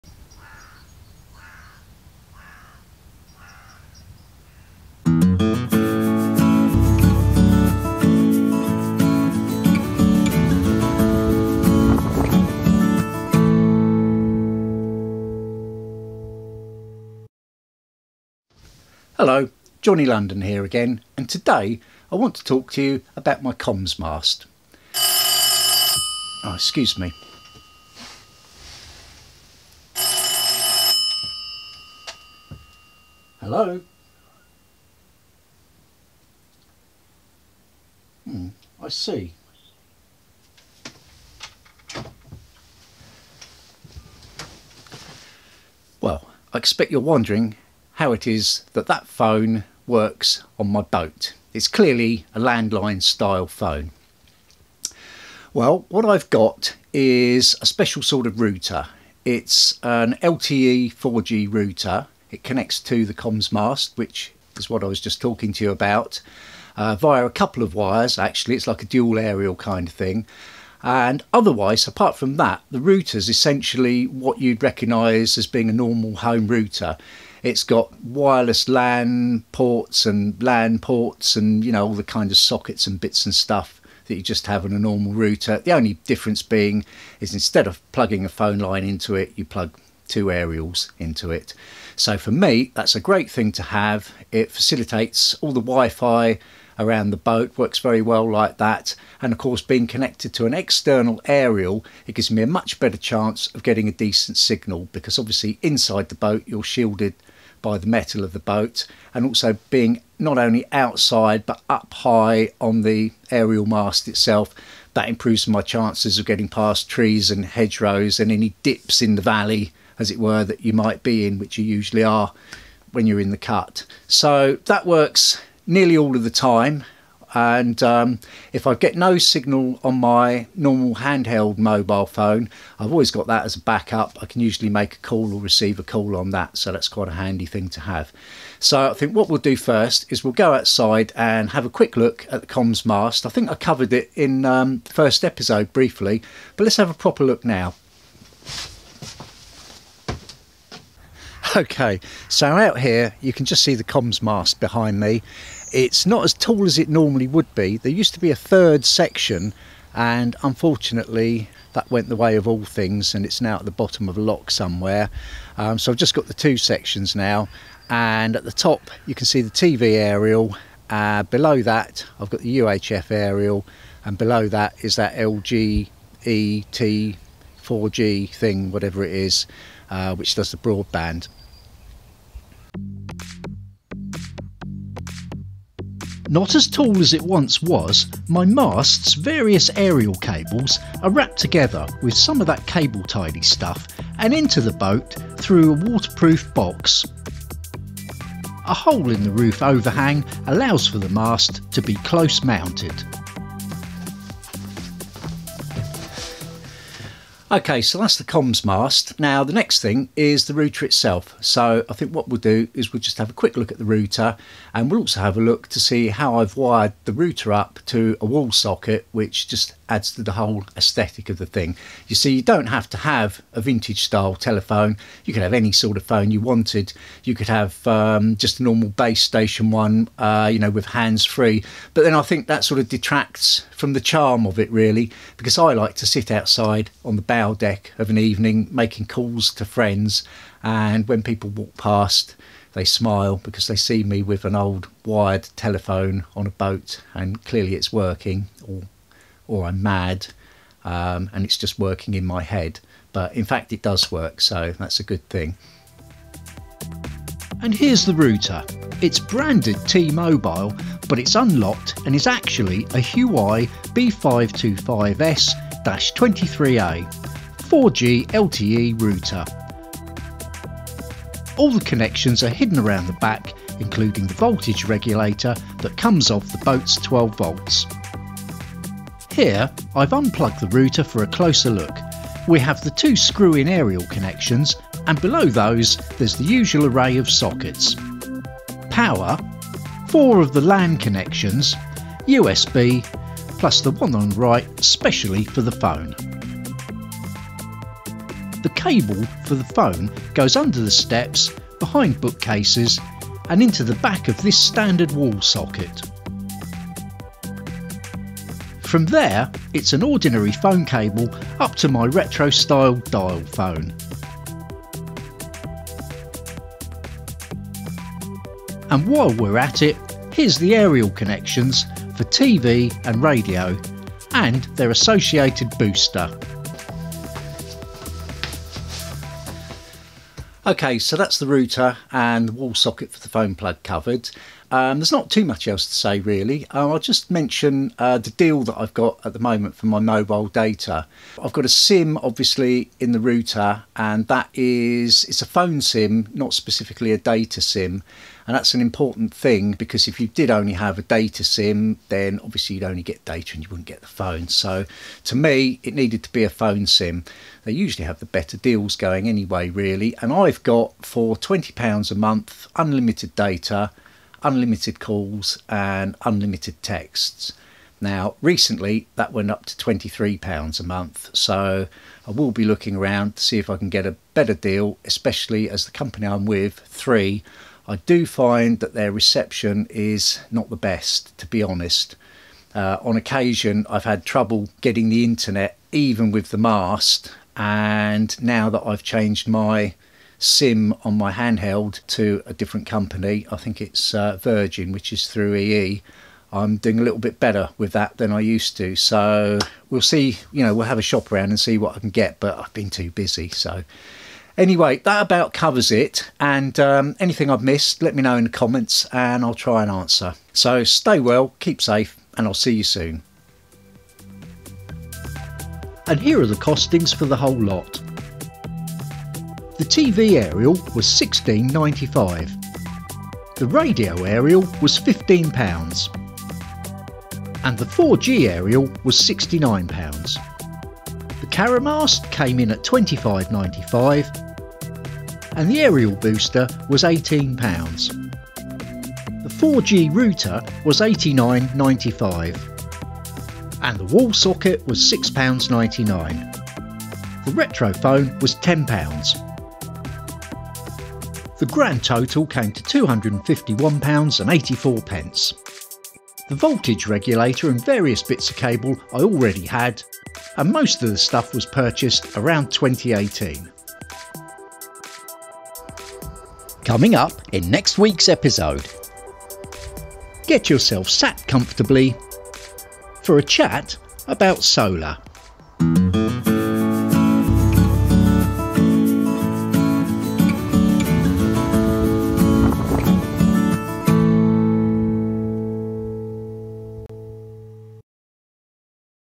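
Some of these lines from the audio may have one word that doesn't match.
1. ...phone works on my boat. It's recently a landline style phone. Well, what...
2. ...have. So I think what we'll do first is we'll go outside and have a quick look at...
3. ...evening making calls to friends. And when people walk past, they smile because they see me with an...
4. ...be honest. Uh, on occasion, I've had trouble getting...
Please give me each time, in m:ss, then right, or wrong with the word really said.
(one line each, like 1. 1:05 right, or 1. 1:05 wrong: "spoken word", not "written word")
1. 0:49 wrong: "clearly", not "recently"
2. 2:17 right
3. 3:58 right
4. 6:21 right.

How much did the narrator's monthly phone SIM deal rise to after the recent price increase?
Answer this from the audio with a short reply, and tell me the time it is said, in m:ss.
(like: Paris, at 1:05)
£23, at 6:09.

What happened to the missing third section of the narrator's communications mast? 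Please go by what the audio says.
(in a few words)
At the bottom of a lock.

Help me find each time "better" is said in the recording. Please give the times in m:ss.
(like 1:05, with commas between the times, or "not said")
1:42, 5:58, 6:14, 6:37.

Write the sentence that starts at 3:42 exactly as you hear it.
You see, you don't have to have a vintage style telephone.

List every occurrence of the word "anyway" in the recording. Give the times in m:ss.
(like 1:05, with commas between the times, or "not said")
5:59, 6:44.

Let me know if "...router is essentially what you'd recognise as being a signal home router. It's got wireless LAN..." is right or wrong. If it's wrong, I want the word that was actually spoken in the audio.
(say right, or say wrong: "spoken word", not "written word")
wrong: "normal", not "signal".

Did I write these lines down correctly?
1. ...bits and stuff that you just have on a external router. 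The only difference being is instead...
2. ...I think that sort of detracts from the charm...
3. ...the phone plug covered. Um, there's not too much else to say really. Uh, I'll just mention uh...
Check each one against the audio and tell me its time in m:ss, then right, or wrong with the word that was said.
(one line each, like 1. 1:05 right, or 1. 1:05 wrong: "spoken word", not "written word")
1. 1:22 wrong: "normal", not "external"
2. 3:52 right
3. 5:33 right.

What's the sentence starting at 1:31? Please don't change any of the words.
So for me, that's a great thing to have.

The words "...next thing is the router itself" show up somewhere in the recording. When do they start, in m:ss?
3:29.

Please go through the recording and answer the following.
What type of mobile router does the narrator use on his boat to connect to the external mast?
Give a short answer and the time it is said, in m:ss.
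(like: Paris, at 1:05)
LTE 4G router, at 1:00.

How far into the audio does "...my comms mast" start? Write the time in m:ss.
0:23.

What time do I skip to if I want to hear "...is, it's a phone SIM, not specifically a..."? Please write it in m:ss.
5:44.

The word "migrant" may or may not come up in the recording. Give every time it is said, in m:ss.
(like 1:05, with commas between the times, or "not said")
not said.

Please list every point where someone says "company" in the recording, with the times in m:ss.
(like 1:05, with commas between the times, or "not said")
6:15, 6:32.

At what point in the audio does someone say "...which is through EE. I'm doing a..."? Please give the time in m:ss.
6:34.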